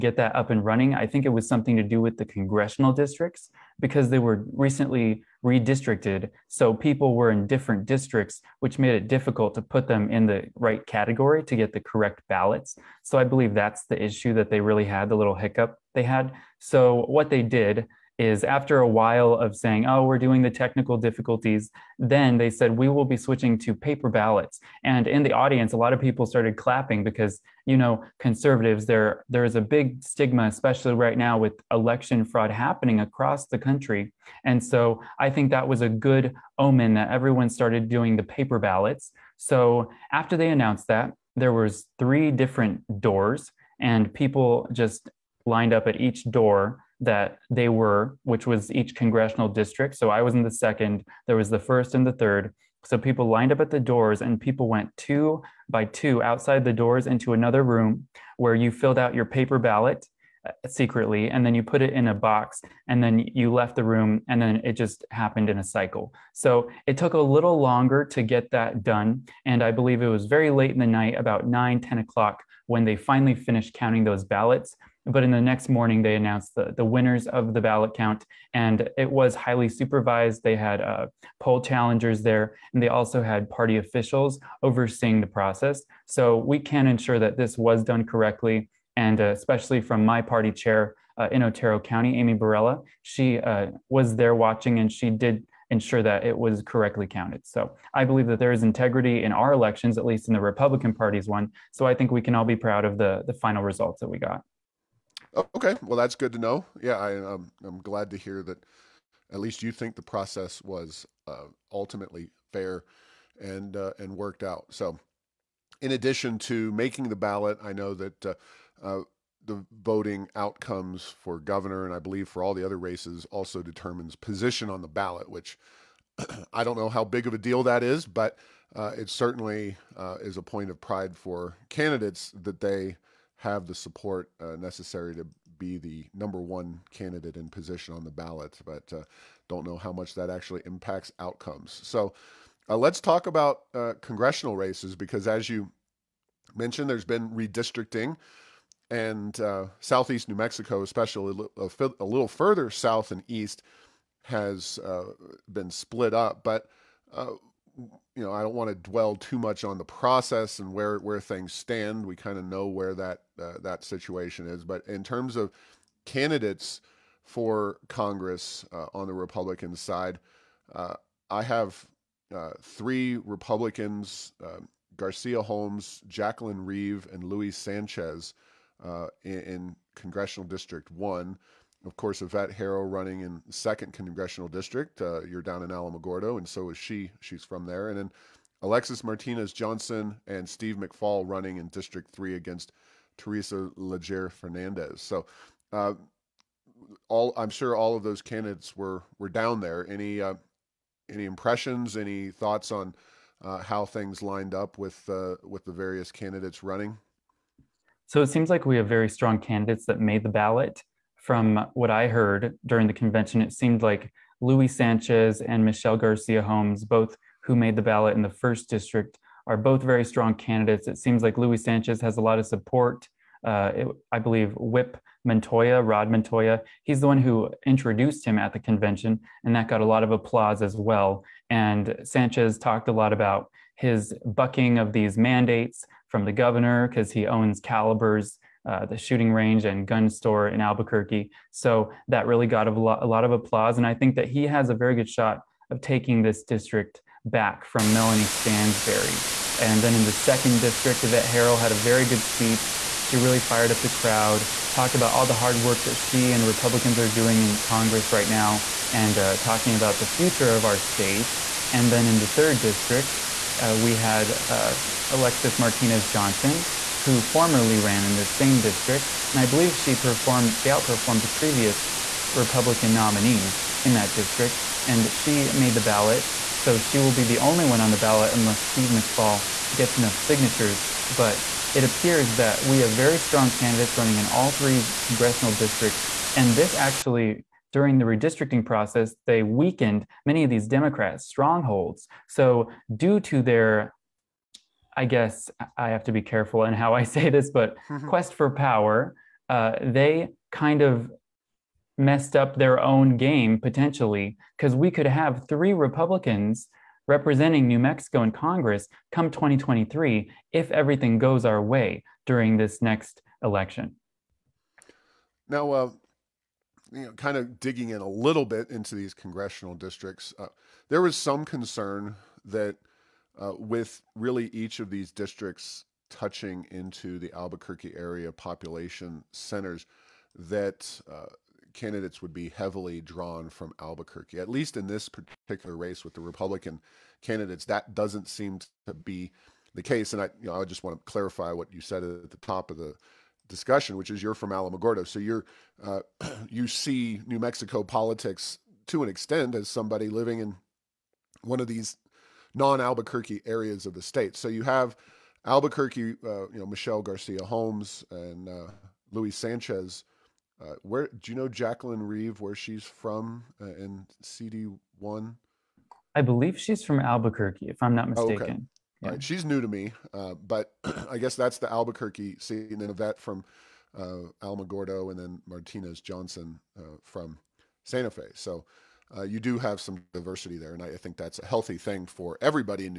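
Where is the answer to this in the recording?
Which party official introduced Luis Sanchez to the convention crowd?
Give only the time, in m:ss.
3:45.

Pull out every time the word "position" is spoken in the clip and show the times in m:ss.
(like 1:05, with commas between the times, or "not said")
2:04, 2:17.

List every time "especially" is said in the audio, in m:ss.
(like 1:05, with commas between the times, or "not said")
0:30, 1:29, 2:30.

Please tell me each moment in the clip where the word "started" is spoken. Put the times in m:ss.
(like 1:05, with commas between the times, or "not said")
0:26, 0:37.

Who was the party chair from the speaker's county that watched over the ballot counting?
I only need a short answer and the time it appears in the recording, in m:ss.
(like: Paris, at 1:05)
Amy Barella, at 1:32.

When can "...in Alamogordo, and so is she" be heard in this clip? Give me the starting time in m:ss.
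3:05.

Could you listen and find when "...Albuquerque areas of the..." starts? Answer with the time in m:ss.
5:52.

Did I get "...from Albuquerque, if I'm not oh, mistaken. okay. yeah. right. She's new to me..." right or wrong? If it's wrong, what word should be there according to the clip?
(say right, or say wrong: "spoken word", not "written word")
right.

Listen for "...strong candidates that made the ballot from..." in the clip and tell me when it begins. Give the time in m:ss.
3:29.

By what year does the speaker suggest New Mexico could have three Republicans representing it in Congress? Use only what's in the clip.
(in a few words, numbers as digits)
2023.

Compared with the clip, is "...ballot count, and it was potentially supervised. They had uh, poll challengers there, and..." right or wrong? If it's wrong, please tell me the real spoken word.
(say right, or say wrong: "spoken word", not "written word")
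wrong: "highly", not "potentially".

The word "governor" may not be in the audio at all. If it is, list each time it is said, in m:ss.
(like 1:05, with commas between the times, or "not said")
2:01, 3:56.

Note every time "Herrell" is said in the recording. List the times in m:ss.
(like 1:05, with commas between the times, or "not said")
3:02, 4:11.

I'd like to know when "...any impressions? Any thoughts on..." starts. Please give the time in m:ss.
3:21.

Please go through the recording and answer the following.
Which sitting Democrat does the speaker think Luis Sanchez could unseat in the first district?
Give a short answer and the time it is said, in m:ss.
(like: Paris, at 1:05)
Melanie Stansbury, at 4:07.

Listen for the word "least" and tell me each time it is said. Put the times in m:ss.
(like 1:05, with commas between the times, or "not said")
1:40, 1:49, 5:34.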